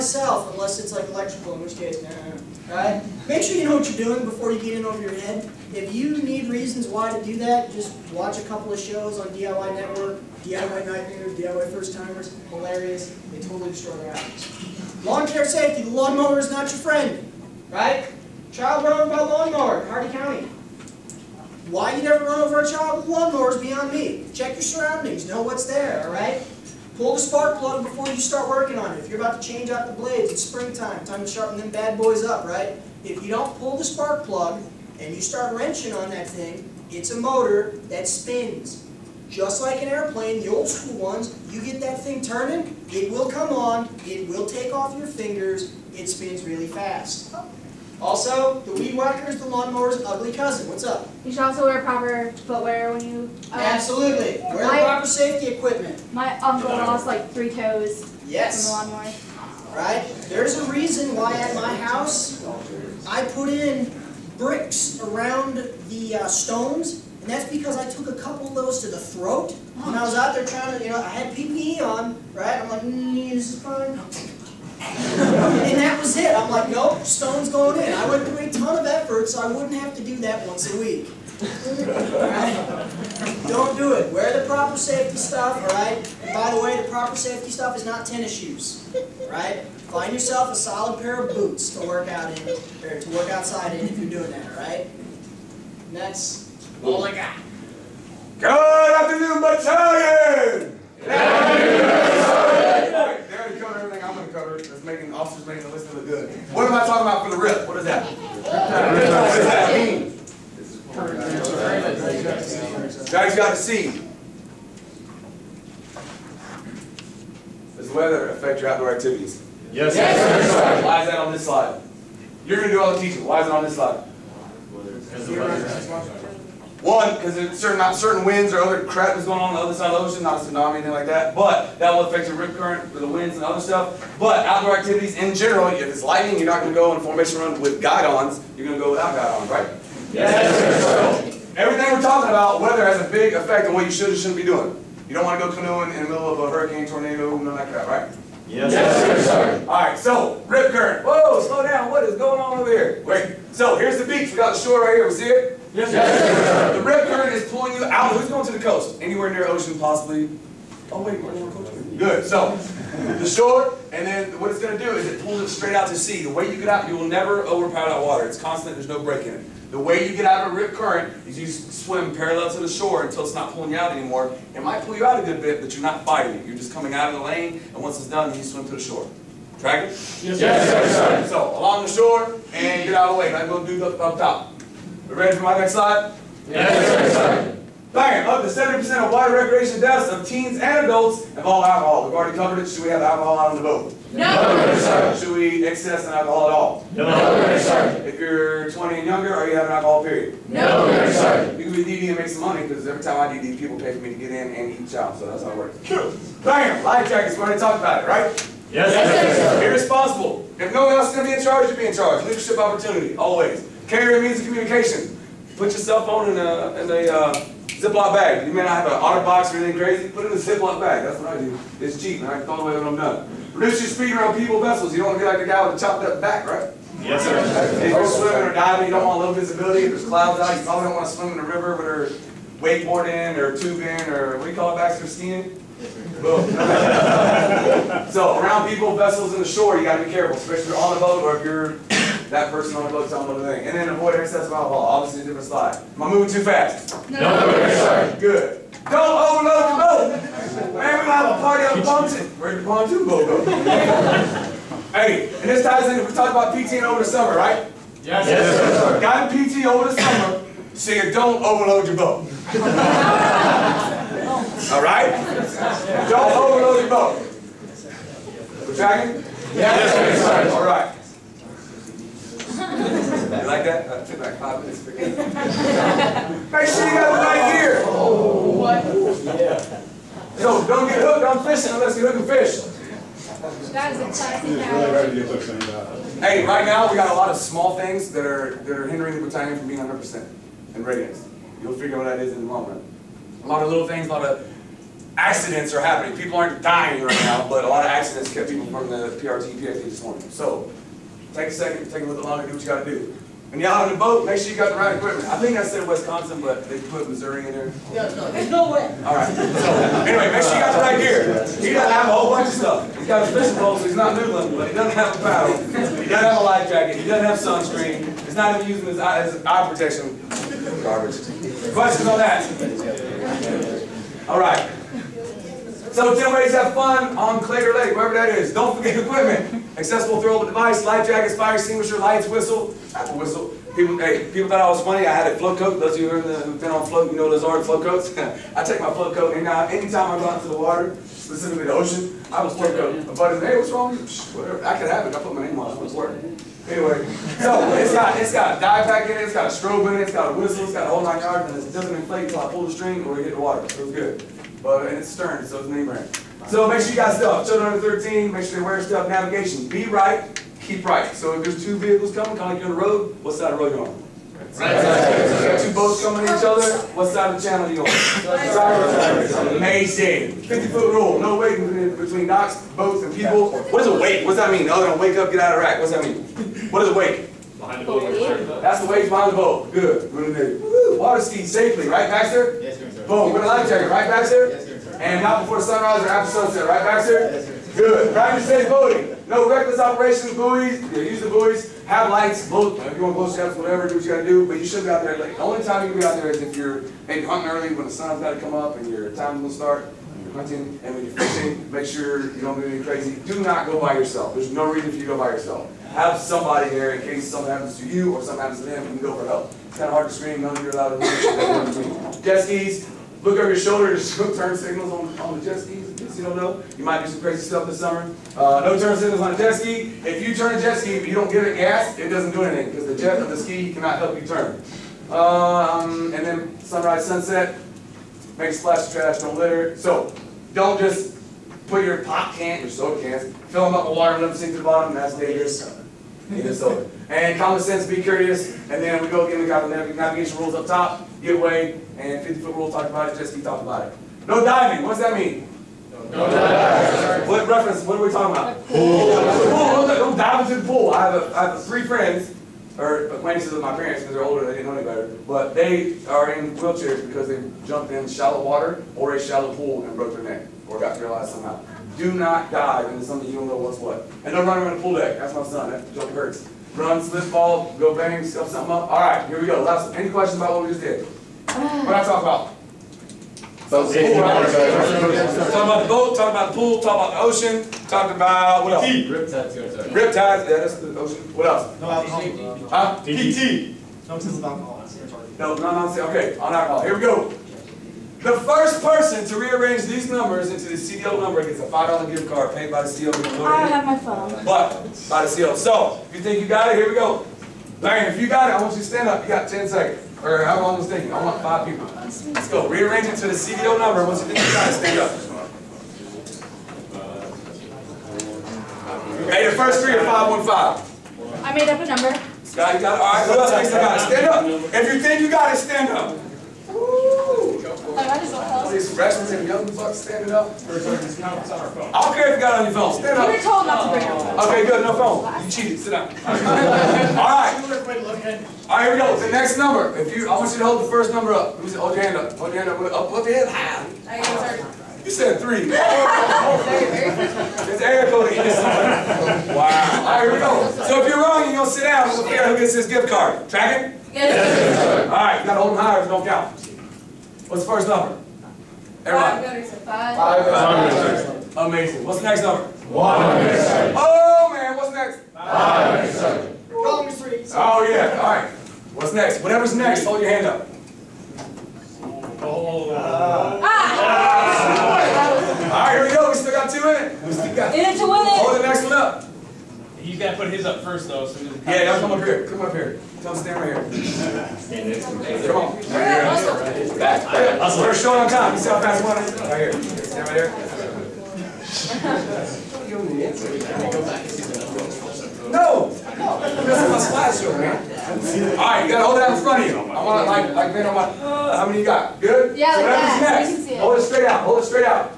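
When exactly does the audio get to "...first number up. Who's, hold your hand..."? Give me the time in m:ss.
8:50.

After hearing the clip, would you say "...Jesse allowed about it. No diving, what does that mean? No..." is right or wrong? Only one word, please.
wrong.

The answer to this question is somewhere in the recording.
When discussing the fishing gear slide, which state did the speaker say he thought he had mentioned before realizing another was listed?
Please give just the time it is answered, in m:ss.
5:05.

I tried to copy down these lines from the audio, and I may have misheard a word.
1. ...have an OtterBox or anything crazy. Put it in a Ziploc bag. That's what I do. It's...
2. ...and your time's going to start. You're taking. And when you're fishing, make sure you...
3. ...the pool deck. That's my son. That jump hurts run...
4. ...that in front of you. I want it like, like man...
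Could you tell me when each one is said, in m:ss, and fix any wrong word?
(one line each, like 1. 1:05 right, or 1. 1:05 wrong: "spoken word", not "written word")
1. 3:38 right
2. 6:38 wrong: "hunting", not "taking"
3. 7:44 right
4. 9:49 right.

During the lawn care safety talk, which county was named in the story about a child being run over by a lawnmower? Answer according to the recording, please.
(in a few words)
Hardy County.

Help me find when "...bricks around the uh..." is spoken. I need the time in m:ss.
1:04.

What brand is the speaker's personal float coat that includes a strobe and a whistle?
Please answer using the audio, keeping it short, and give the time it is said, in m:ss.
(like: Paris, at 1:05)
Stearns, at 5:55.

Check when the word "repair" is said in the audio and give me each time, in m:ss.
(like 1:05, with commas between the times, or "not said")
not said.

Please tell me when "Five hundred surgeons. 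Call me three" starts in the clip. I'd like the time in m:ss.
9:15.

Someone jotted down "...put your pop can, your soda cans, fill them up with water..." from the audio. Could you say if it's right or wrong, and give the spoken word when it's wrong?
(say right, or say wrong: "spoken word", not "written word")
right.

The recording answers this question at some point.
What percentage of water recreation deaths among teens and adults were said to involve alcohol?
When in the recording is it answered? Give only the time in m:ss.
3:08.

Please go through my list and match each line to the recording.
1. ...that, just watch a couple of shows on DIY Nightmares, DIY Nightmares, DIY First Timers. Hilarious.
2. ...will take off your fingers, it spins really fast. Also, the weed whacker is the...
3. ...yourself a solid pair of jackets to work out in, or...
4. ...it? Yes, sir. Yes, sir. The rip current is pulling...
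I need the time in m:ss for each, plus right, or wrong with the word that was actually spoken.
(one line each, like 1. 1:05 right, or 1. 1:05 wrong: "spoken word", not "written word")
1. 0:07 wrong: "Network", not "Nightmares"
2. 0:44 right
3. 1:30 wrong: "boots", not "jackets"
4. 2:35 right.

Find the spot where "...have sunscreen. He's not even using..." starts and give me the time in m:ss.
5:17.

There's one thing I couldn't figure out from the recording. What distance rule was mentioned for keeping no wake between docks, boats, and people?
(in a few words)
50 foot.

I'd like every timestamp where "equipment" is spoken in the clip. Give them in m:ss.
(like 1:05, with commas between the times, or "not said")
0:55, 5:04, 5:28.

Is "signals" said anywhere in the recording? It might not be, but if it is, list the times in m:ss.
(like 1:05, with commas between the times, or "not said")
6:54, 6:58.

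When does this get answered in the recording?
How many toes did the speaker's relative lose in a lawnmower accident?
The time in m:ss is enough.
0:57.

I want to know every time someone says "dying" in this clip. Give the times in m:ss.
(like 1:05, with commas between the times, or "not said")
4:56.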